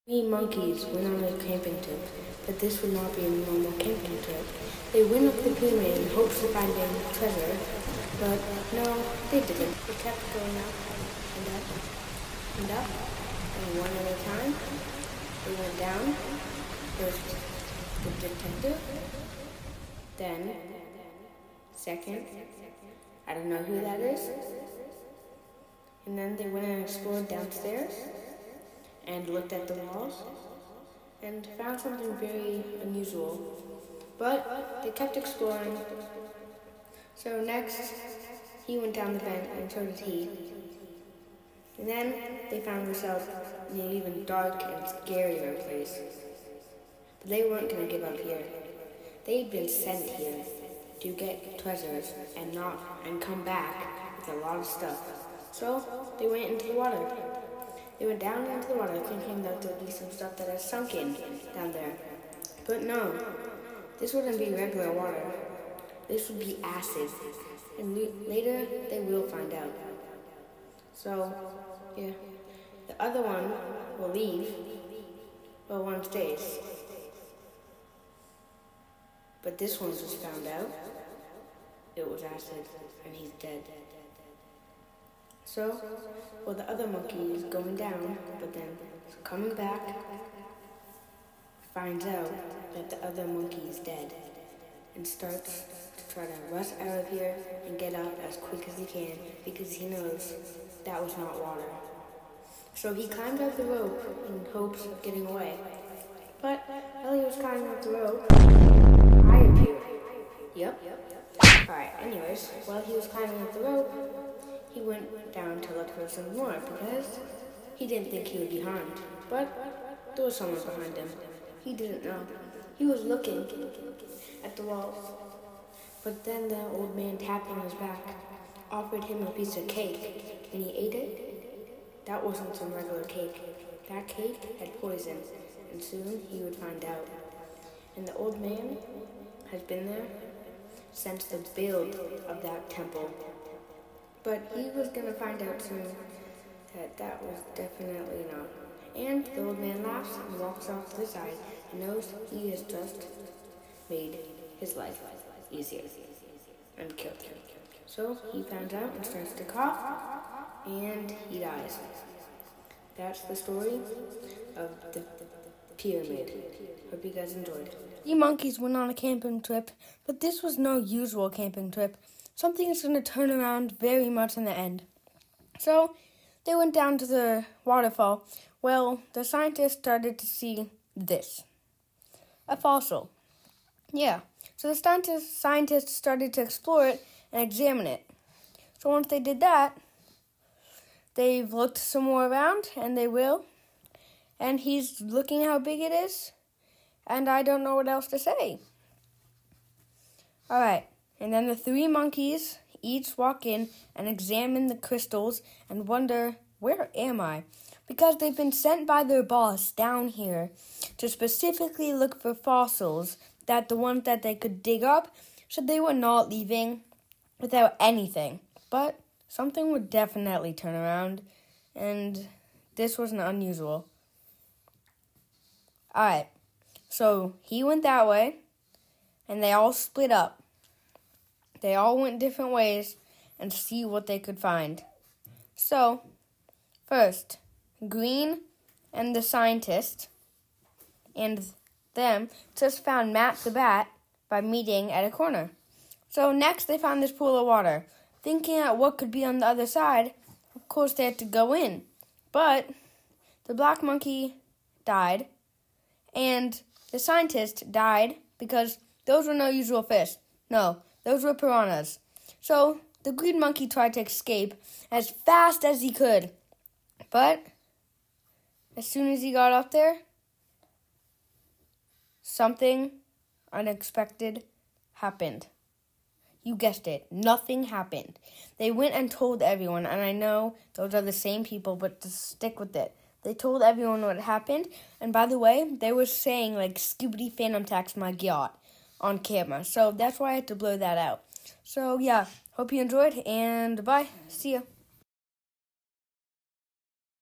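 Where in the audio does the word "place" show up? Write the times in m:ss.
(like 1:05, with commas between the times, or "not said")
0:45.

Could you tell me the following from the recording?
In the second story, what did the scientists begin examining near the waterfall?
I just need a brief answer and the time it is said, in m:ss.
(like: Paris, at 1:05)
A fossil, at 3:02.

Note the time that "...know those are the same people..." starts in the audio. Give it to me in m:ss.
4:40.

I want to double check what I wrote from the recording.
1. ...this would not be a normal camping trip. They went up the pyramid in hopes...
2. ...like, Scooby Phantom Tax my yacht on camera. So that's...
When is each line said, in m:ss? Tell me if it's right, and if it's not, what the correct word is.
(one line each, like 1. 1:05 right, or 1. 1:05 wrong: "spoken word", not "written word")
1. 0:02 right
2. 4:46 right.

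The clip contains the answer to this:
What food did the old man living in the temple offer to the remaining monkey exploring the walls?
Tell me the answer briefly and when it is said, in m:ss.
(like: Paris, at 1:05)
A piece of cake, at 2:09.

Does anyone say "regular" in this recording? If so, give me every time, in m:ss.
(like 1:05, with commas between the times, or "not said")
1:04, 2:12.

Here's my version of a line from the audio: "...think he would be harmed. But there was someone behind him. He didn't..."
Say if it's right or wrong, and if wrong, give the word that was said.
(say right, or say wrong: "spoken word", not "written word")
right.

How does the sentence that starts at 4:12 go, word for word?
But the black monkey died and the scientist died because those were no usual fish.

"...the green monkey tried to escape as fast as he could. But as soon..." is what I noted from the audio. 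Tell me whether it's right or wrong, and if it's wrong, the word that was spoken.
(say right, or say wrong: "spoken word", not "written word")
right.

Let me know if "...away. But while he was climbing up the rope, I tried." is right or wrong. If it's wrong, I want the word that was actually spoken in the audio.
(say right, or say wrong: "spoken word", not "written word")
wrong: "appeared", not "tried".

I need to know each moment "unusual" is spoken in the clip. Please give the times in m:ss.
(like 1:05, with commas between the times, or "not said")
0:32, 3:43.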